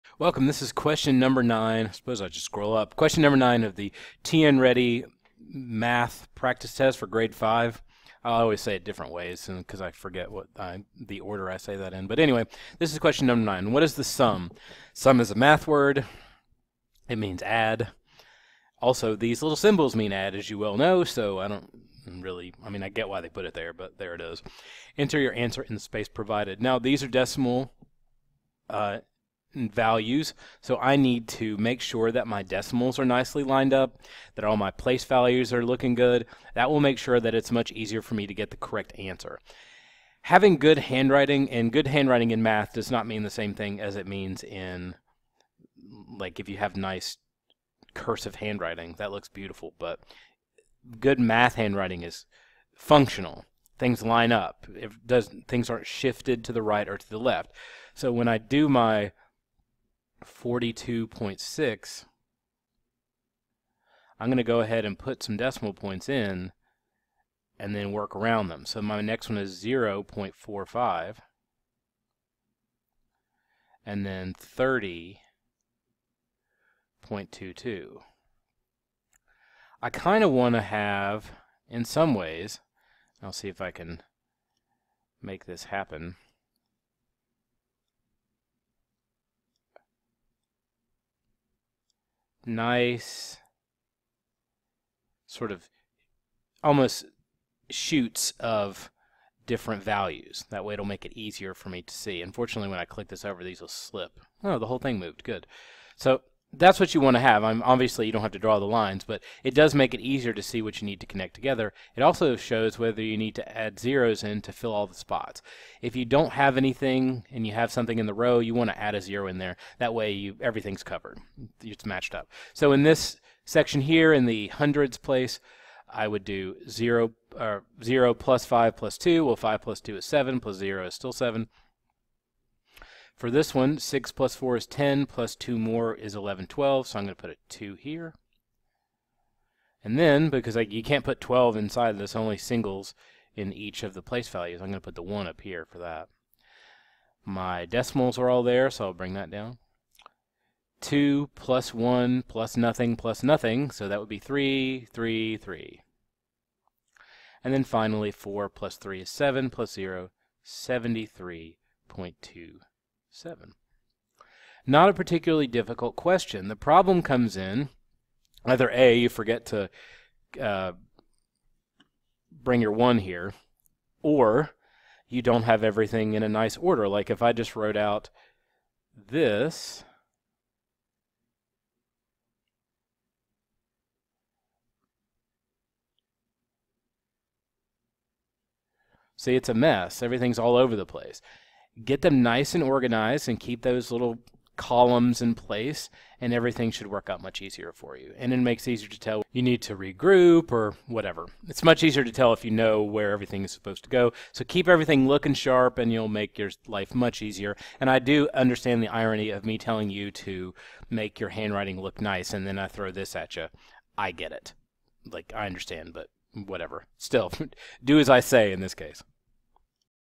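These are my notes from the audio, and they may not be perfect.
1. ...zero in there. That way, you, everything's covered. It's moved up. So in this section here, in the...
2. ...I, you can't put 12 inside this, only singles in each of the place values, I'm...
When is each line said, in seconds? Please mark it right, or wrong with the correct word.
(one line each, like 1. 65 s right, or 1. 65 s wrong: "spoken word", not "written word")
1. 119 s wrong: "matched", not "moved"
2. 140 s right.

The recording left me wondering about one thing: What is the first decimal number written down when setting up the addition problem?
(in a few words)
42.6.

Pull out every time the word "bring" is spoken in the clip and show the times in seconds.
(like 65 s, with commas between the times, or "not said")
148 s, 172 s.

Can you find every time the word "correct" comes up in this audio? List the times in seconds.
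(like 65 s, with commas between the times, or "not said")
38 s.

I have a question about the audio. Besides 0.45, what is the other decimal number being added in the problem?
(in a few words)
30.22.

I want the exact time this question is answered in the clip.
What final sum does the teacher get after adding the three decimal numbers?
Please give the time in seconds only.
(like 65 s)
160 s.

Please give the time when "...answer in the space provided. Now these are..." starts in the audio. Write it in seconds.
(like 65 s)
25 s.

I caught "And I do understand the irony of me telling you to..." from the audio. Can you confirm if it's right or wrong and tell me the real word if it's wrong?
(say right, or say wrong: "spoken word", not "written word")
right.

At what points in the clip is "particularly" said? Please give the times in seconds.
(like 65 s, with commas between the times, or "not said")
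164 s.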